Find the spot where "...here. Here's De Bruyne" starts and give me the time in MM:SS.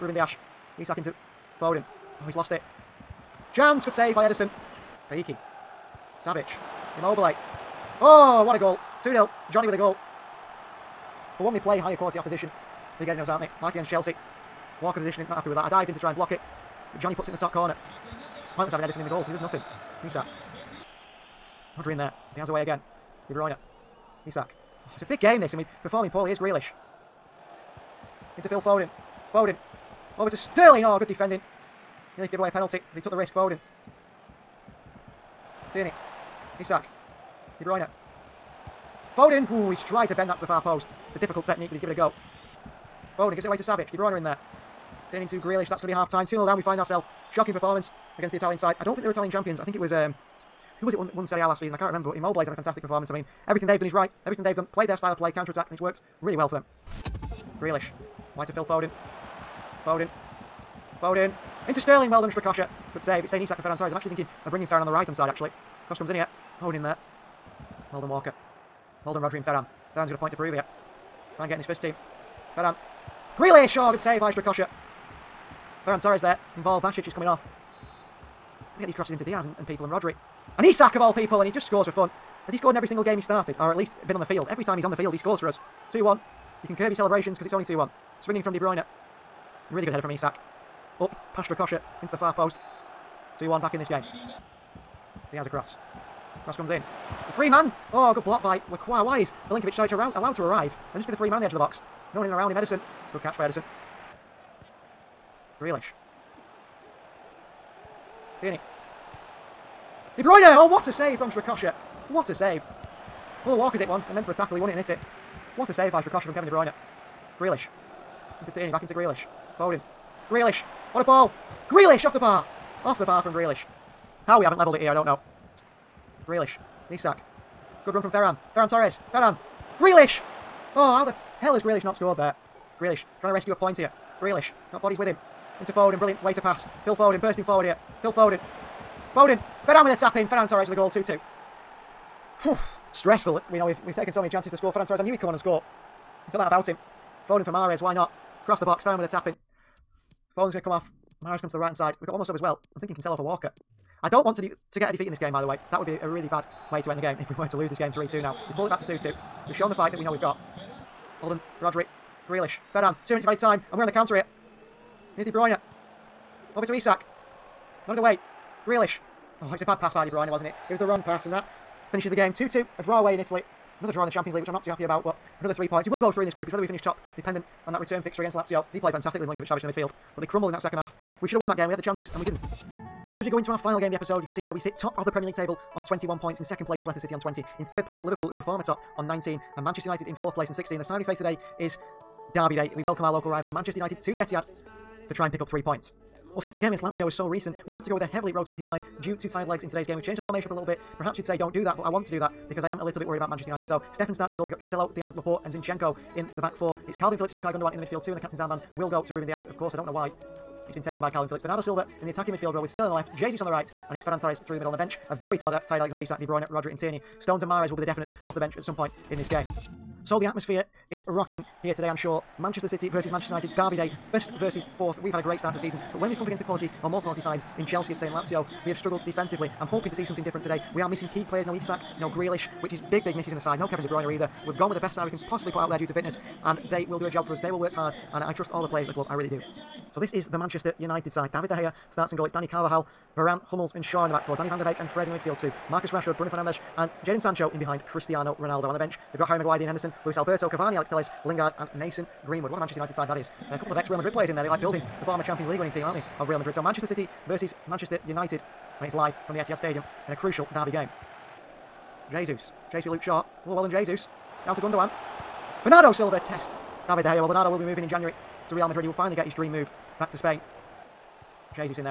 02:44.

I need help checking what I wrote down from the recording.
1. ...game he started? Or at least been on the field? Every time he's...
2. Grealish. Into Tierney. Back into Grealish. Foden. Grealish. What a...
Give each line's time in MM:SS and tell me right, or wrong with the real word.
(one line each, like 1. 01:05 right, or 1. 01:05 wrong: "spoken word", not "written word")
1. 01:23 right
2. 01:57 right.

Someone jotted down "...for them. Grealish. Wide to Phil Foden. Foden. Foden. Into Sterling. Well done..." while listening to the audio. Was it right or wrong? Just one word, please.
right.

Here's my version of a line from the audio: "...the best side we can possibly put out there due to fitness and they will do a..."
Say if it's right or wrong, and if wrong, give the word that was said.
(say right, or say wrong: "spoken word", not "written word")
right.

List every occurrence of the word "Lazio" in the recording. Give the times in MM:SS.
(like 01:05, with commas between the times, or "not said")
02:58, 03:16, 03:48.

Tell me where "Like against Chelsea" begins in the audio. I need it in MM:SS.
00:13.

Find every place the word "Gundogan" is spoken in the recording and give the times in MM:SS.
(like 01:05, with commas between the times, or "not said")
03:27, 04:24.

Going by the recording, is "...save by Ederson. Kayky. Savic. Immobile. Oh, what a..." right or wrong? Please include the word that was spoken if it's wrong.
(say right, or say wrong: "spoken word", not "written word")
right.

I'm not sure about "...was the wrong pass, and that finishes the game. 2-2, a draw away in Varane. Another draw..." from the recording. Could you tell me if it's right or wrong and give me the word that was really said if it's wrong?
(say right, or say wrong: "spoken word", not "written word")
wrong: "Italy", not "Varane".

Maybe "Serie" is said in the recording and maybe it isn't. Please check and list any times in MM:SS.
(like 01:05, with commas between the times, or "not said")
00:51.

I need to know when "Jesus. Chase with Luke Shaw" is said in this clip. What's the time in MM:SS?
04:22.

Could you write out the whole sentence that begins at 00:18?
It's pointless having Ederson in the goal because he does nothing.